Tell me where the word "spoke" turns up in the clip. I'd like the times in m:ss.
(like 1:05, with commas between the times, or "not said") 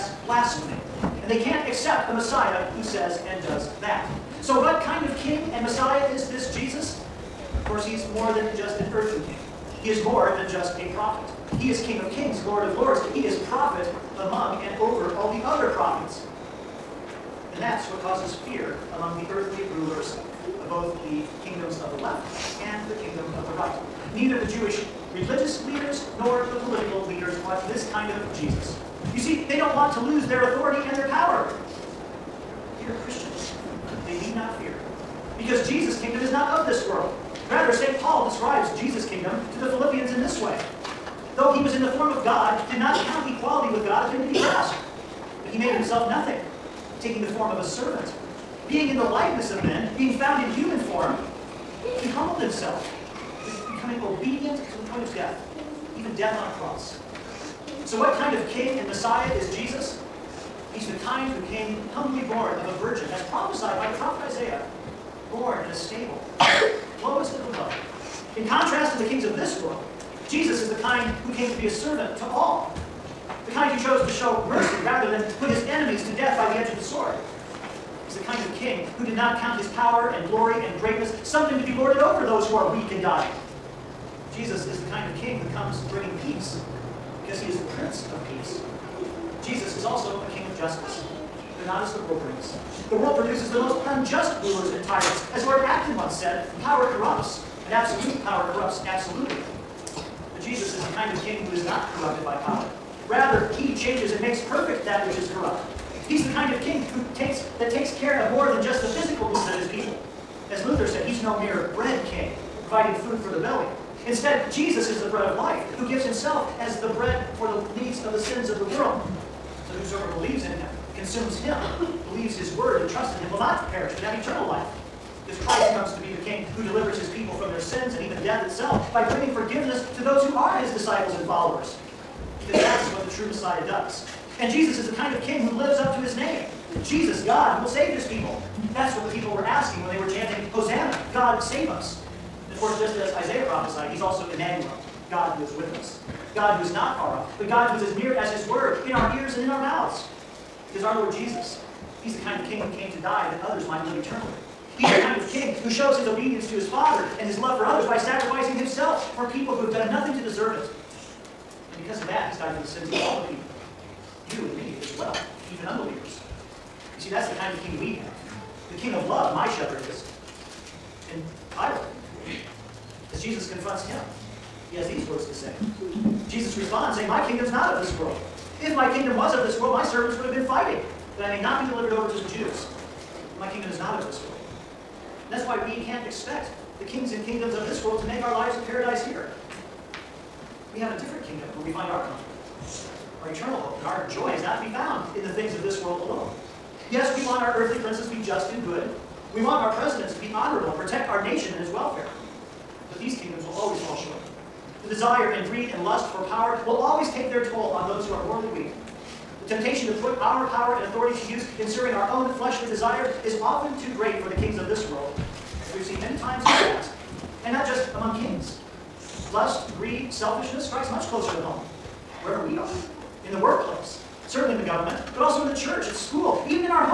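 not said.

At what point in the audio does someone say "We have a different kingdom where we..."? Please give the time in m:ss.
3:10.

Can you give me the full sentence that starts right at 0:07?
Of course, he's more than just an earthly king.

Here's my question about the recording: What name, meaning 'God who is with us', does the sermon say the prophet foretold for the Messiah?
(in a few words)
Emmanuel.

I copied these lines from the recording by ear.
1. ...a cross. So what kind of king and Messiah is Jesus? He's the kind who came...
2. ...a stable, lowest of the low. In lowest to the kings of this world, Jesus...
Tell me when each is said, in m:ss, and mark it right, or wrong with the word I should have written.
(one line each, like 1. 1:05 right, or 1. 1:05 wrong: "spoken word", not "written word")
1. 0:56 right
2. 1:05 wrong: "contrast", not "lowest".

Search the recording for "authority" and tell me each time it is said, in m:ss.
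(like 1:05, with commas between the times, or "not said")
0:30, 3:30.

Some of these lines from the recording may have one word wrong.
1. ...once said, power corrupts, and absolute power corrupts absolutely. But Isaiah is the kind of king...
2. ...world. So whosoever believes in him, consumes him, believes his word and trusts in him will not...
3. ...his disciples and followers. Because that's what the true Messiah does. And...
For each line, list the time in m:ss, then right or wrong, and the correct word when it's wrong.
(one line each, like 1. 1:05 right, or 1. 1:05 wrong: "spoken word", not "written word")
1. 1:35 wrong: "Jesus", not "Isaiah"
2. 1:58 right
3. 2:10 right.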